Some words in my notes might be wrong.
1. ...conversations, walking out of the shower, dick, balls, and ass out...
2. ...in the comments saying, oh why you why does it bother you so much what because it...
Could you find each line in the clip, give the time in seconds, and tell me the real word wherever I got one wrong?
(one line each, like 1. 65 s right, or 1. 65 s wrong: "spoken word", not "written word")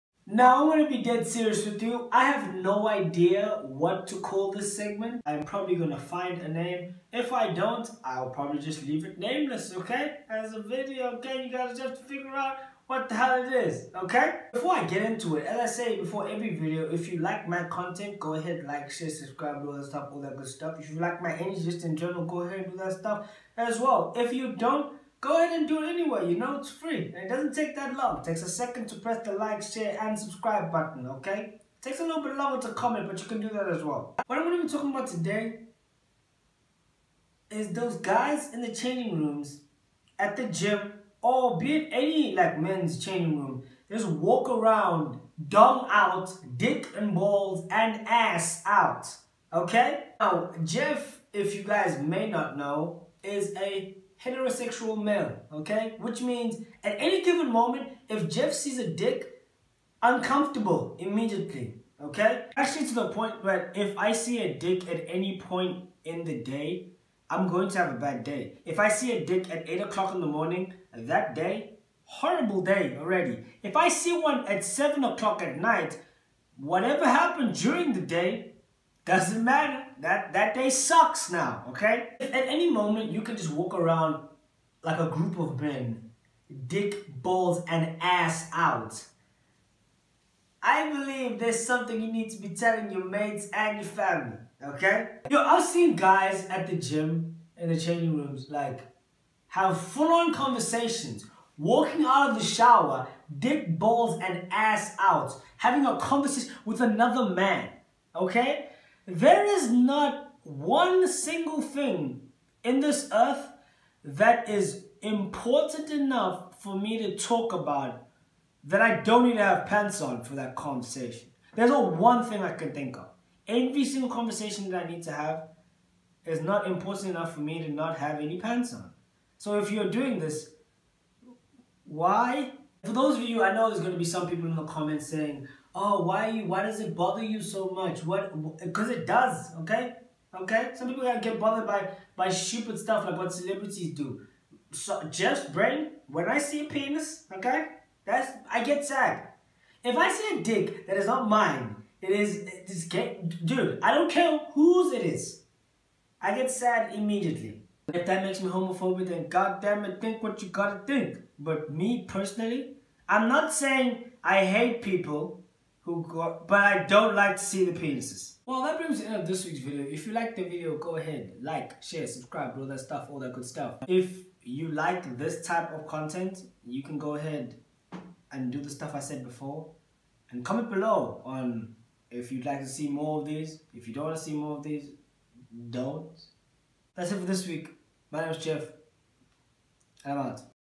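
1. 100 s right
2. 134 s right.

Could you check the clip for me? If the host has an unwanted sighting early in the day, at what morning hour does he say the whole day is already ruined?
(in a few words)
8 o'clock.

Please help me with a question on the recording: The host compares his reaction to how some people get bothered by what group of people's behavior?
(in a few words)
celebrities.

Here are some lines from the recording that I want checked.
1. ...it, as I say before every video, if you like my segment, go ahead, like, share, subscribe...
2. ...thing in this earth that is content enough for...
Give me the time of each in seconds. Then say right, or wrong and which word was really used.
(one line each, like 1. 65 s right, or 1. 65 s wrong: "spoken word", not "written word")
1. 15 s wrong: "content", not "segment"
2. 111 s wrong: "important", not "content".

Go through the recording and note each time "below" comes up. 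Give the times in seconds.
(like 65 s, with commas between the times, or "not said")
180 s.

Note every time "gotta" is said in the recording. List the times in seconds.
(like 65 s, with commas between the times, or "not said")
160 s.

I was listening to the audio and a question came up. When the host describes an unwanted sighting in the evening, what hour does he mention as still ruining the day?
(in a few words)
7 o'clock.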